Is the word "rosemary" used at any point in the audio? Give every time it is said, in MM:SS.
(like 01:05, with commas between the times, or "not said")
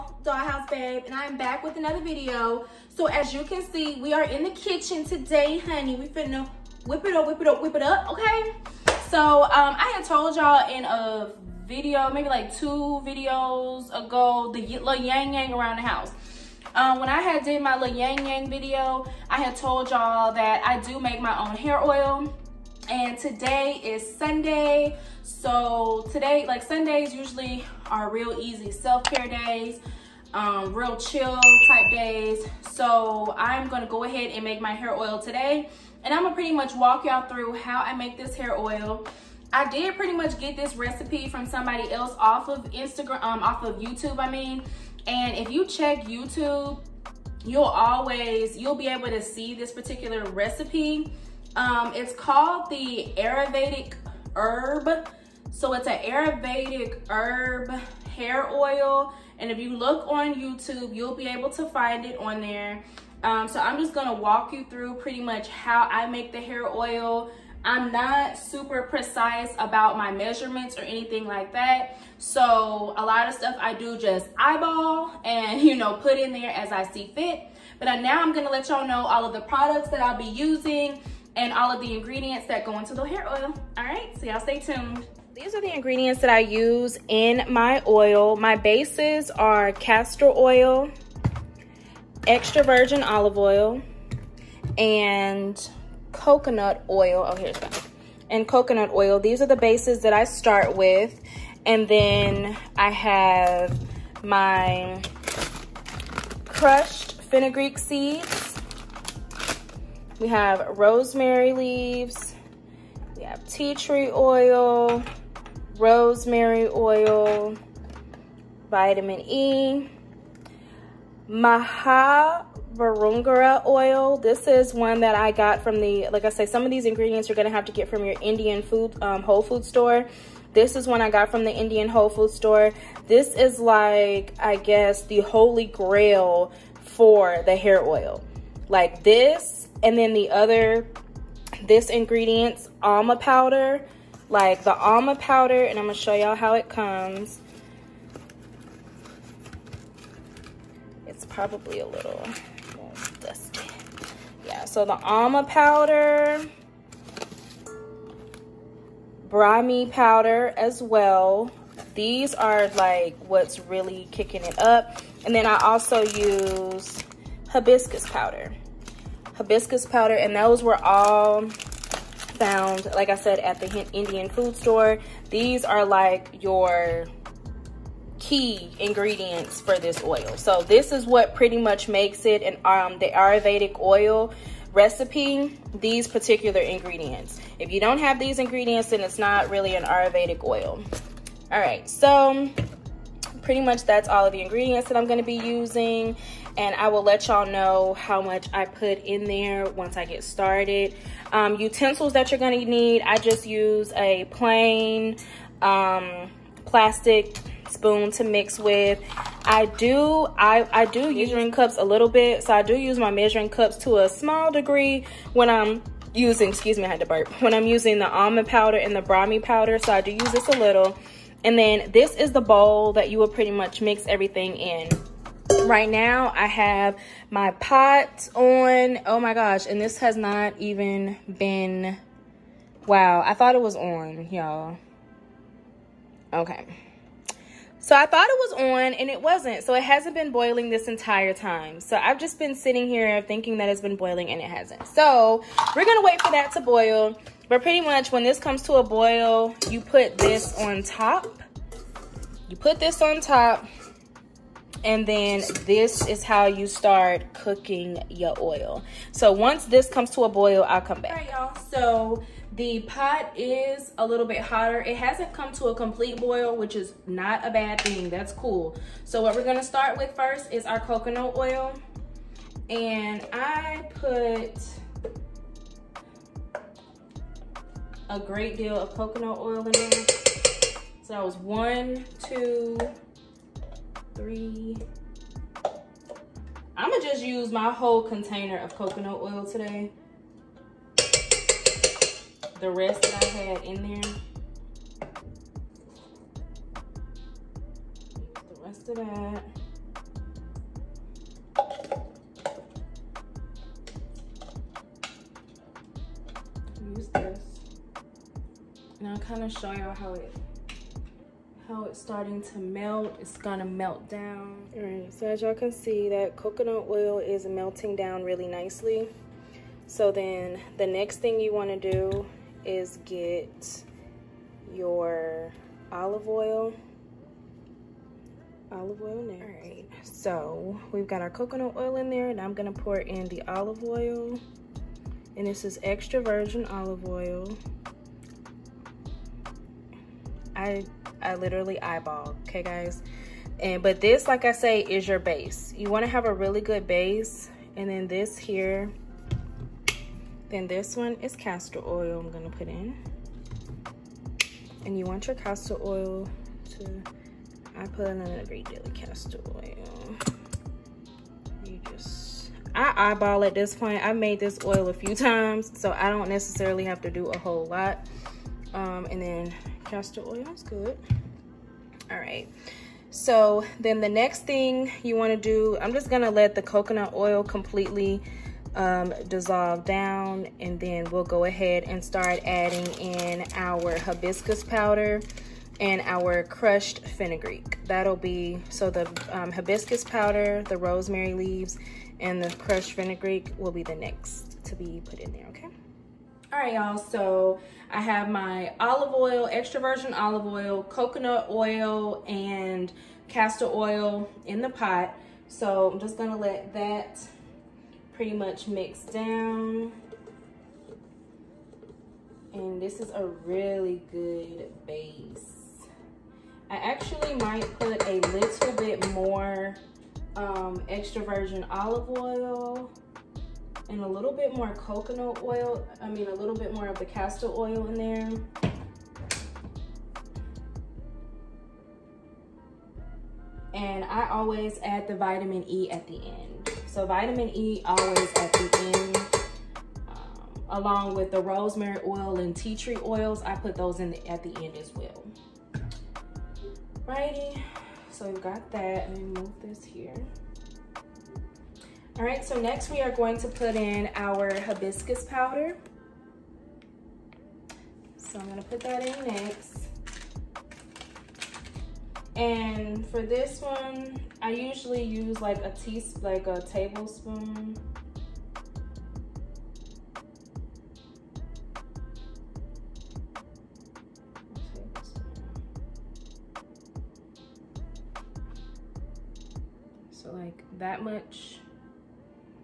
01:50, 01:55, 06:30, 07:21.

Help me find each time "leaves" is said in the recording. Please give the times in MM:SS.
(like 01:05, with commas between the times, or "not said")
01:51, 06:31.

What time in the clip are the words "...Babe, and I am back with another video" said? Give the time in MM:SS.
00:00.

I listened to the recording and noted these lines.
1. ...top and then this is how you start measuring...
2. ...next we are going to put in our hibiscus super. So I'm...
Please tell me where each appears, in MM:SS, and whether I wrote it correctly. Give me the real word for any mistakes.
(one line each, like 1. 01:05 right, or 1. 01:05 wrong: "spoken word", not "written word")
1. 04:13 wrong: "cooking", not "measuring"
2. 07:32 wrong: "powder", not "super".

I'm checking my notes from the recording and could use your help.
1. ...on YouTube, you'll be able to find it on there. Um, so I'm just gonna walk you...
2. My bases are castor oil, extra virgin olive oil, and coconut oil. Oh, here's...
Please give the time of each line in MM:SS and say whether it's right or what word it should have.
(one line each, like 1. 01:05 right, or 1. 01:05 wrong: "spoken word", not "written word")
1. 01:00 right
2. 01:28 right.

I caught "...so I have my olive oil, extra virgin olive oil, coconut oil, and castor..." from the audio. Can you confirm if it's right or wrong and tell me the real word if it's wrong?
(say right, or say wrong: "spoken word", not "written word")
right.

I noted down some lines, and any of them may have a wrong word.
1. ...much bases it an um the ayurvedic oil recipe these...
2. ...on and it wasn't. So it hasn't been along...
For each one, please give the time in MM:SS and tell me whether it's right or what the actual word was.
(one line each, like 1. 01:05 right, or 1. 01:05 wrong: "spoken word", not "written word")
1. 03:01 wrong: "makes", not "bases"
2. 03:58 wrong: "boiling", not "along".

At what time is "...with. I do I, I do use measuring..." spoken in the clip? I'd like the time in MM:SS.
03:28.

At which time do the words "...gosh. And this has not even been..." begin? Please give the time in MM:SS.
03:49.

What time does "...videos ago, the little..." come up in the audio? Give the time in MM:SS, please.
00:13.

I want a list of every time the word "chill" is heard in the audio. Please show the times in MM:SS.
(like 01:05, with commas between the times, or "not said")
00:30.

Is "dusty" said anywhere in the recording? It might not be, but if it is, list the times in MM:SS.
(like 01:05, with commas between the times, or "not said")
02:33.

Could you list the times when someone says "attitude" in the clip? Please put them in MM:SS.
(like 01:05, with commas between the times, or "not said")
not said.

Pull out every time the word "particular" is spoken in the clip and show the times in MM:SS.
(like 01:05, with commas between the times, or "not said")
00:49, 03:06.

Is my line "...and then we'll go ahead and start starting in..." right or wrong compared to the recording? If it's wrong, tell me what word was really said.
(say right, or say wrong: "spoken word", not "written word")
wrong: "adding", not "starting".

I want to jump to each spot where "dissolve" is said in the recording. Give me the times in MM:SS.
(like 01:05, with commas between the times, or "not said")
06:19.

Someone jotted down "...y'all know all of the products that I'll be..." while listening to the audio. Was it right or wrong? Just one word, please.
right.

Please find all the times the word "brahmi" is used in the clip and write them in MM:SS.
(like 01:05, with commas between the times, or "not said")
02:39, 03:39.